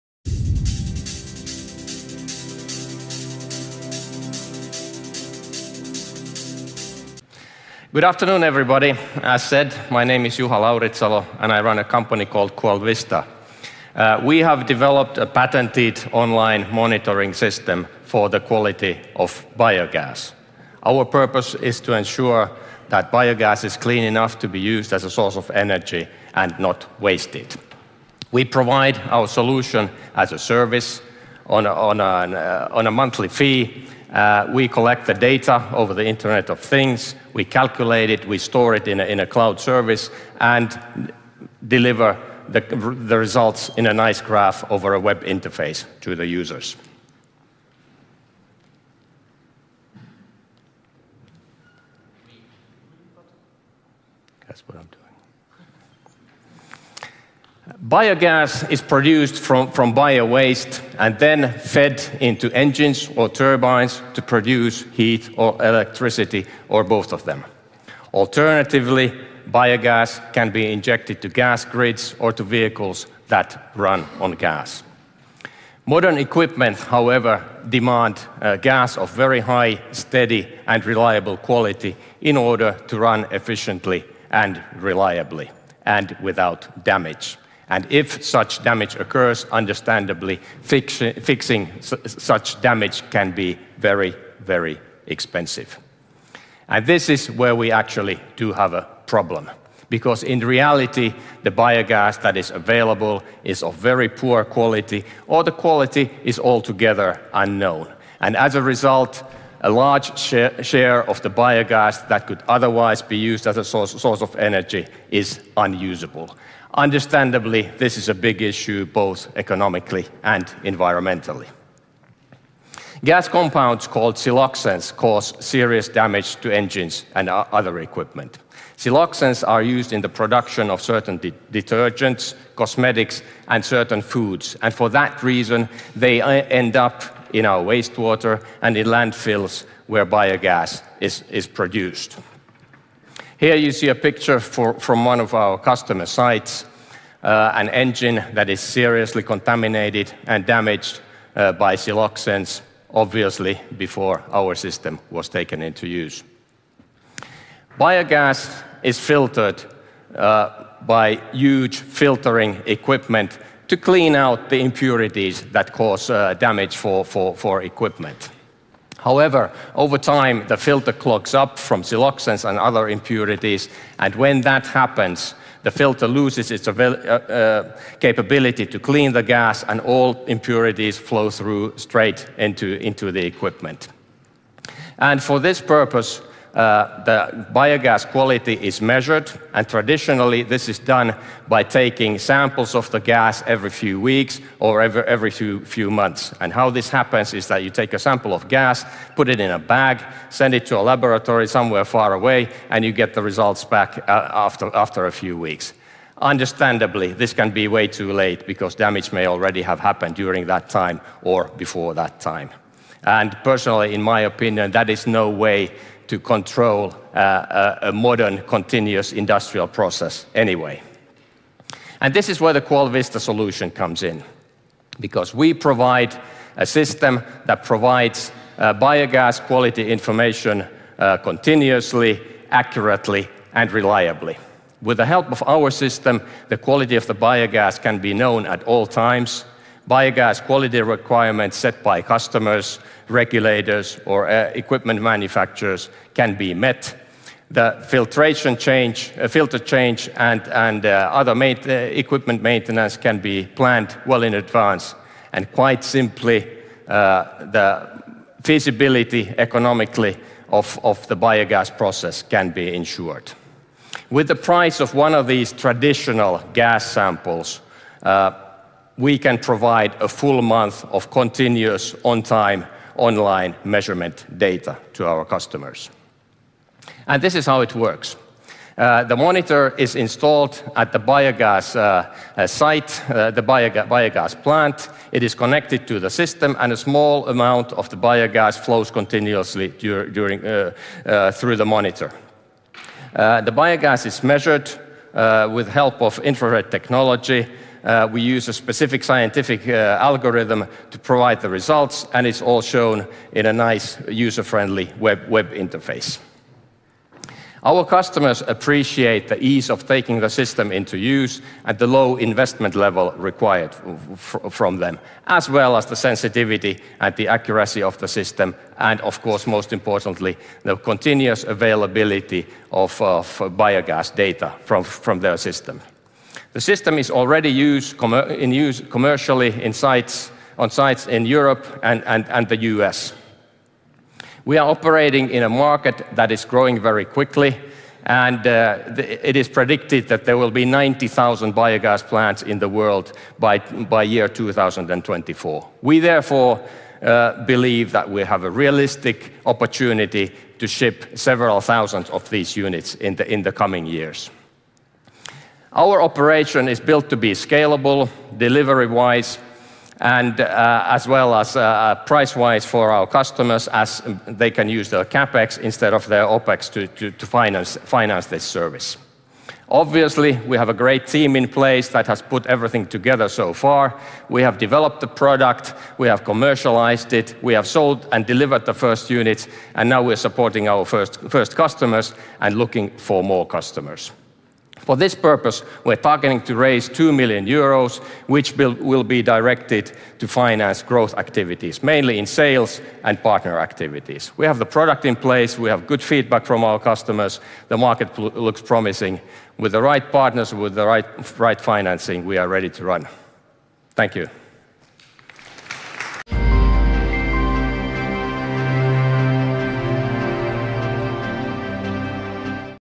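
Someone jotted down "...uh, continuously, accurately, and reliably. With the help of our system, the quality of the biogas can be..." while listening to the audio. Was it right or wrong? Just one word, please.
right.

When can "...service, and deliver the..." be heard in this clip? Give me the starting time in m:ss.
0:39.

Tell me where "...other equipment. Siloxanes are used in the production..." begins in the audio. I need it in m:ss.
2:07.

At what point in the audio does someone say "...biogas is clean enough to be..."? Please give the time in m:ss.
0:23.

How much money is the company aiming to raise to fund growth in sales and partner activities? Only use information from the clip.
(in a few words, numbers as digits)
2 million euros.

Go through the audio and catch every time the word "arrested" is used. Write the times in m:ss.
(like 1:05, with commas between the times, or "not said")
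not said.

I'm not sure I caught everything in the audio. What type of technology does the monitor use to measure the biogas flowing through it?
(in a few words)
infrared.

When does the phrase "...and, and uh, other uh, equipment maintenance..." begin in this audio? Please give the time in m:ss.
4:10.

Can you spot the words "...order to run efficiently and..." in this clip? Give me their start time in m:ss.
1:22.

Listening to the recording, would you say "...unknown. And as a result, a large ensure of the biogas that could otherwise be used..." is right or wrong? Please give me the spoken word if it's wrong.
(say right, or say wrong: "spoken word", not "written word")
wrong: "share", not "ensure".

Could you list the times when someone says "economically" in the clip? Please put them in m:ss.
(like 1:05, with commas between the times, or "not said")
1:59, 4:19.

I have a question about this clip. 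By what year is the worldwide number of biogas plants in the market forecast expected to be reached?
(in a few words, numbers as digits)
2024.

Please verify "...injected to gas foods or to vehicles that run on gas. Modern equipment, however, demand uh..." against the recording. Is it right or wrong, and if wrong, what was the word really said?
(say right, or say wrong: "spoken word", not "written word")
wrong: "grids", not "foods".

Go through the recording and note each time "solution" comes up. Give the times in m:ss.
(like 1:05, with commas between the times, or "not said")
0:29, 3:43.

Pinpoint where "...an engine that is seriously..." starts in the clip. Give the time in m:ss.
2:27.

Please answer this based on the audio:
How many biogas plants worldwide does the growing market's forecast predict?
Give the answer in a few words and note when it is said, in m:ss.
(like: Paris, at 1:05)
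90,000, at 5:40.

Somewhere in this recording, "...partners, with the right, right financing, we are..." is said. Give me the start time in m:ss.
6:40.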